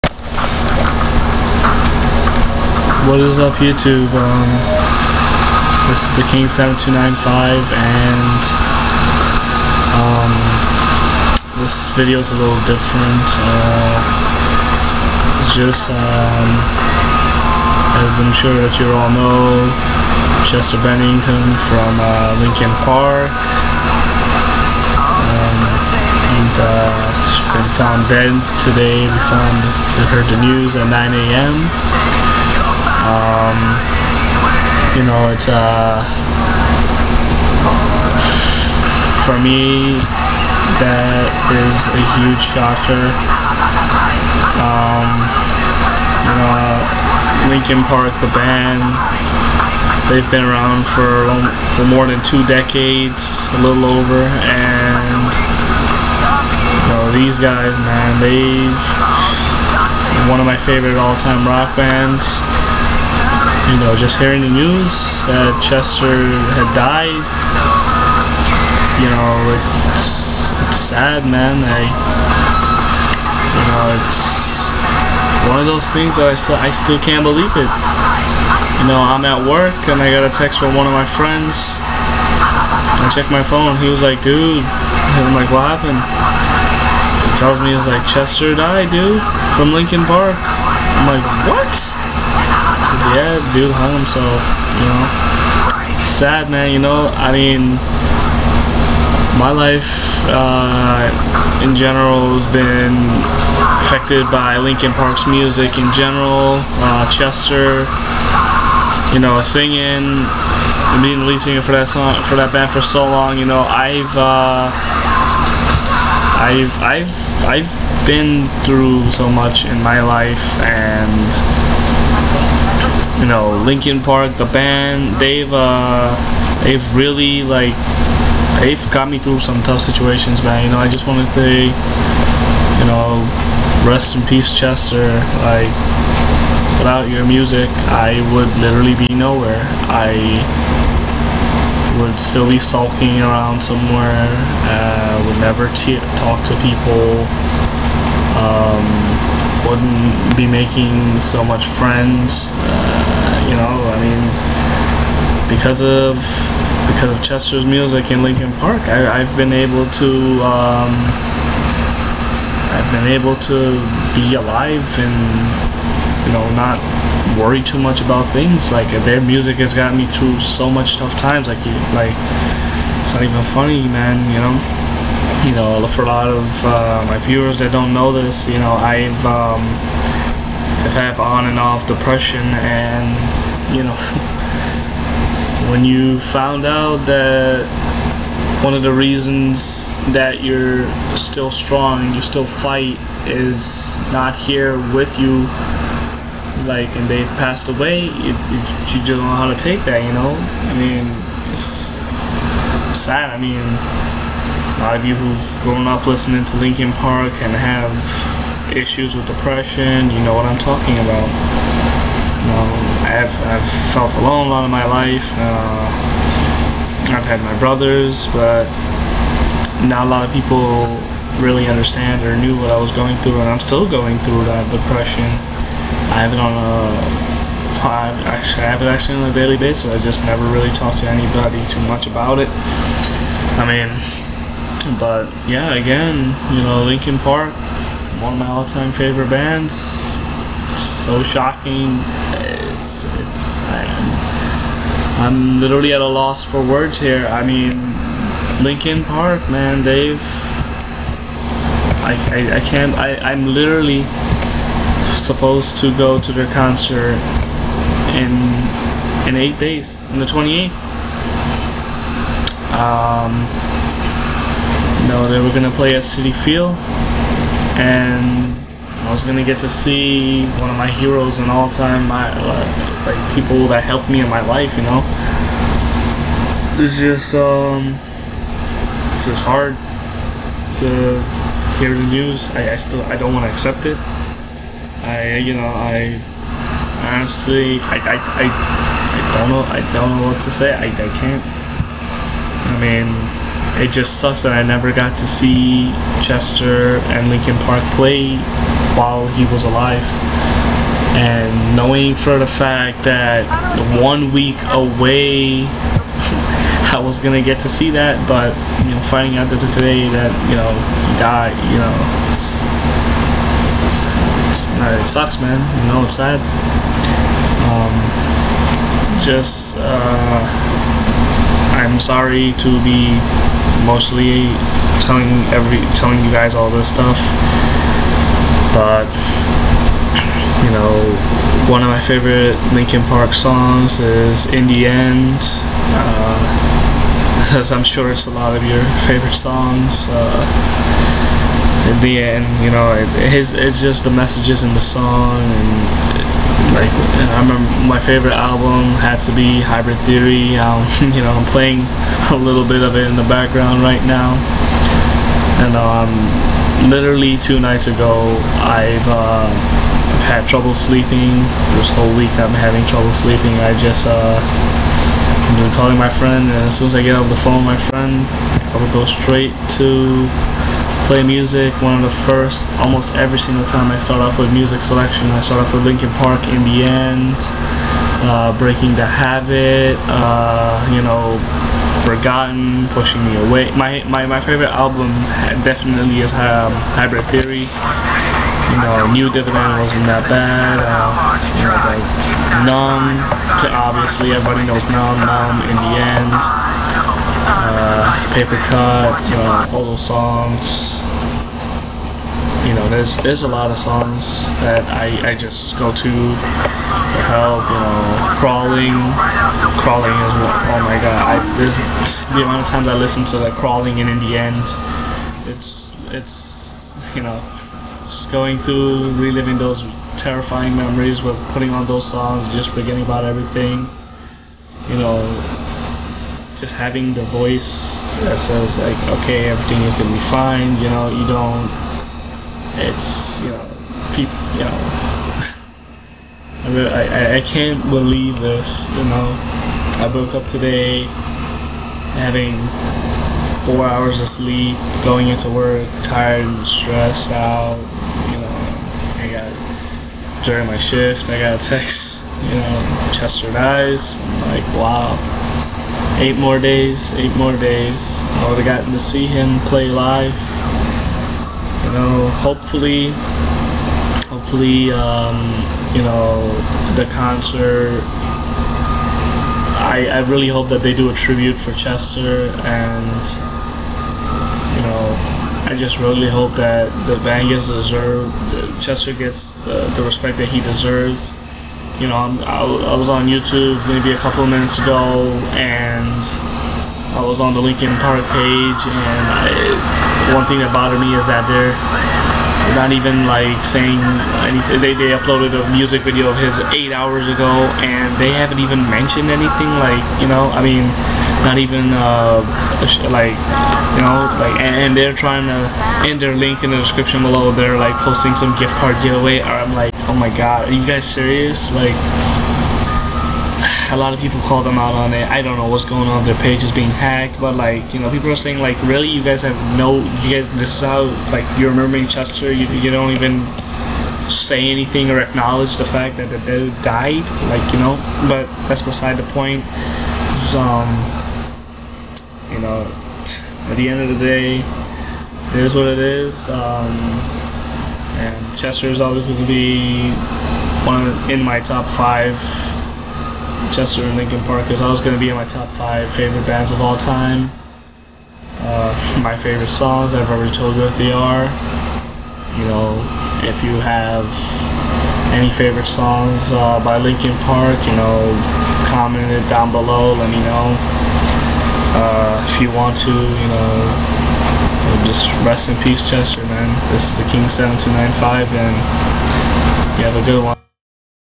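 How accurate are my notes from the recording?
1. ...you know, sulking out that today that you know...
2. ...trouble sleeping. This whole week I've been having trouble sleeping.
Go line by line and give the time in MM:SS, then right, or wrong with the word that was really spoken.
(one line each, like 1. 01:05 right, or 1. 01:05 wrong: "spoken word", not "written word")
1. 05:08 wrong: "finding", not "sulking"
2. 06:00 right.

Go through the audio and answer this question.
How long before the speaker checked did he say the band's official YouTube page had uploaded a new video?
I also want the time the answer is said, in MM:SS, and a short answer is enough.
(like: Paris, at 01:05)
8 hours ago, at 08:16.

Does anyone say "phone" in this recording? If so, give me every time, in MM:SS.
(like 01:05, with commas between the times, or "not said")
01:23, 06:07.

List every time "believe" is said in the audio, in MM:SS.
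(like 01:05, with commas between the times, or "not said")
01:17, 07:17.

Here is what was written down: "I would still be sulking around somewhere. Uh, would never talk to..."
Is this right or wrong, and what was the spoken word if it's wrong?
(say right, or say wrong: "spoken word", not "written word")
right.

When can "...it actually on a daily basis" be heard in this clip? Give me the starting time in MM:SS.
03:48.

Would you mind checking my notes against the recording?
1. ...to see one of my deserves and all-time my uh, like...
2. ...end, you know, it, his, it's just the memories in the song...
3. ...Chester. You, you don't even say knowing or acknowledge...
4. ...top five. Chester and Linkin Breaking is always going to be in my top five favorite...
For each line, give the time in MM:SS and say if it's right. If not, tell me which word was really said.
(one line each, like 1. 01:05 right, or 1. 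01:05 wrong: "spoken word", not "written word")
1. 04:29 wrong: "heroes", not "deserves"
2. 05:42 wrong: "messages", not "memories"
3. 08:42 wrong: "anything", not "knowing"
4. 09:01 wrong: "Park", not "Breaking".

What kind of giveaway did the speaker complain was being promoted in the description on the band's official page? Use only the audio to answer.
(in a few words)
gift card giveaway.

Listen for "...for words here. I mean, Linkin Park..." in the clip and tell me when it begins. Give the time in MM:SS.
04:06.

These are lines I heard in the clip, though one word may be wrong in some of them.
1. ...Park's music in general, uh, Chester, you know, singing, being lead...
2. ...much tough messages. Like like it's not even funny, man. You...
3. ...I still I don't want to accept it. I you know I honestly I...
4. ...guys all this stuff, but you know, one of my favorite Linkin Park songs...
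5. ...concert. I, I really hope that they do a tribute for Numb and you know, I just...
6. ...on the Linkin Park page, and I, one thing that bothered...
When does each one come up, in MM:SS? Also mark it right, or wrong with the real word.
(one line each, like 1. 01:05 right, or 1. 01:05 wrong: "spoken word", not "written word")
1. 01:44 right
2. 02:50 wrong: "times", not "messages"
3. 04:42 right
4. 05:26 right
5. 07:47 wrong: "Chester", not "Numb"
6. 08:07 right.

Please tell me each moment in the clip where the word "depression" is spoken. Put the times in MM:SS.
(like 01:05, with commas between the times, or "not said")
03:01, 03:29, 03:44.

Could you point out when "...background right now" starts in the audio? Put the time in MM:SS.
05:53.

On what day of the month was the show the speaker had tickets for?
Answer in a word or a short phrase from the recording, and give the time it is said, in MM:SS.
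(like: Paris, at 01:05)
28th, at 04:20.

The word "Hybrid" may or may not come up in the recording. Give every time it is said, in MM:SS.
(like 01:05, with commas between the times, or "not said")
05:49, 06:26.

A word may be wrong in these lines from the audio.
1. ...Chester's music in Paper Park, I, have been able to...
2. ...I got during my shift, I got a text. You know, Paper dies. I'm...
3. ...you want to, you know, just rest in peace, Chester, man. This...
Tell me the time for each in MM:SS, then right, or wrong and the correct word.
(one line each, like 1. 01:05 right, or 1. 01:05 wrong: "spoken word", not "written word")
1. 02:37 wrong: "Linkin", not "Paper"
2. 07:29 wrong: "Chester", not "Paper"
3. 09:22 right.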